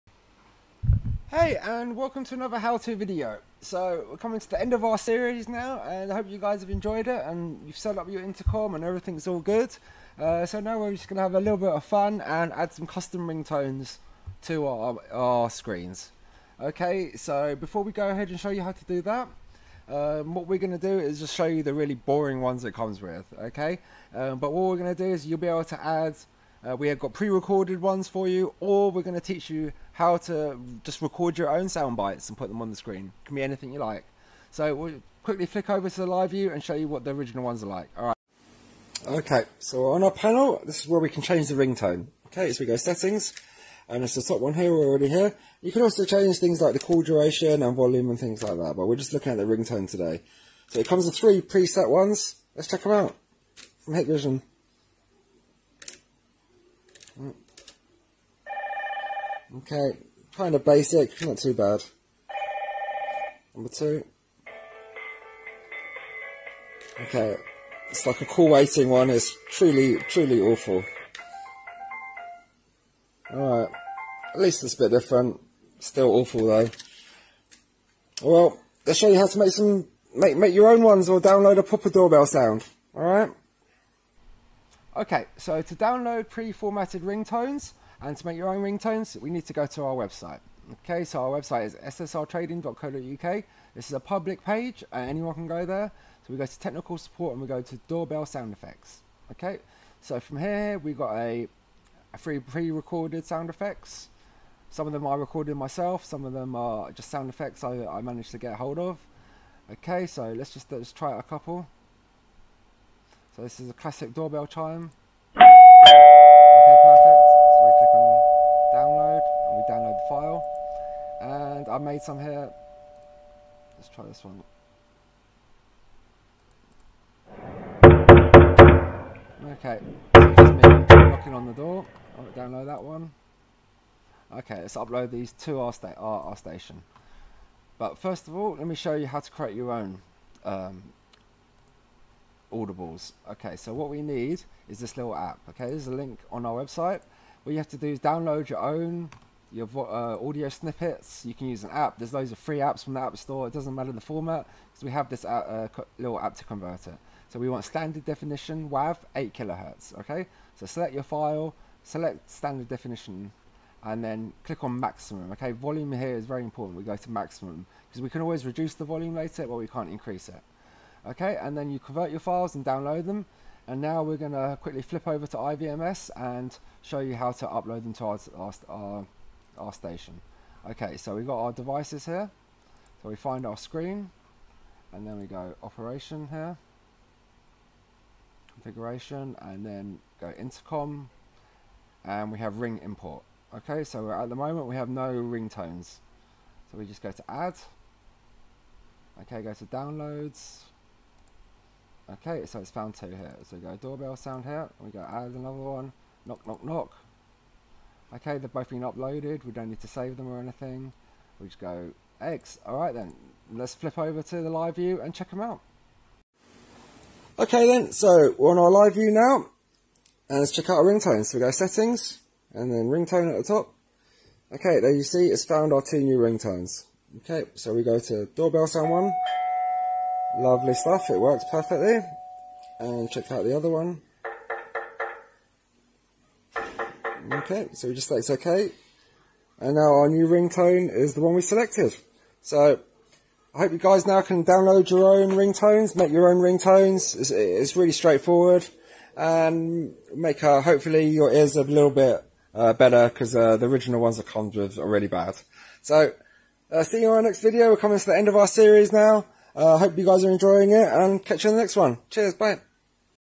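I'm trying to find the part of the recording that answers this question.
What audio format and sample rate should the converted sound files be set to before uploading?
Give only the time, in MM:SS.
02:38.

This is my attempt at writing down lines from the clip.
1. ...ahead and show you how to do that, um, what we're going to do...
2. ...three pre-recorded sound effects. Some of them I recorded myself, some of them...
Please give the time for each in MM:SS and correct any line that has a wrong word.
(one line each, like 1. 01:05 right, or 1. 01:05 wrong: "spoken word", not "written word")
1. 00:18 right
2. 01:42 right.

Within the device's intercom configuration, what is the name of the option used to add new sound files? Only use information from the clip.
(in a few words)
ring import.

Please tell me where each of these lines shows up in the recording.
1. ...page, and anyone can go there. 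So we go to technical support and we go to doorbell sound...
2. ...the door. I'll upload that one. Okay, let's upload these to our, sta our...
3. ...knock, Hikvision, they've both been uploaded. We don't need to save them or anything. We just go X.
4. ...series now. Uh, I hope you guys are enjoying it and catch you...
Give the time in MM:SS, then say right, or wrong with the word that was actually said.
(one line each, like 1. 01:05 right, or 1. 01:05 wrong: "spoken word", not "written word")
1. 01:34 right
2. 02:11 wrong: "download", not "upload"
3. 03:26 wrong: "Okay", not "Hikvision"
4. 04:18 right.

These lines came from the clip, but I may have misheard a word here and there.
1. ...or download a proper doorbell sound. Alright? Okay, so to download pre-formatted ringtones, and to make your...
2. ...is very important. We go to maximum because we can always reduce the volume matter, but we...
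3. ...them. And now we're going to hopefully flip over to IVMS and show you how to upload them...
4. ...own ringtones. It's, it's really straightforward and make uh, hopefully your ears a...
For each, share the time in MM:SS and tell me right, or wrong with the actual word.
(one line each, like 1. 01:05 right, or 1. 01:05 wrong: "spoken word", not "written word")
1. 01:21 right
2. 02:46 wrong: "later", not "matter"
3. 02:53 wrong: "quickly", not "hopefully"
4. 04:06 right.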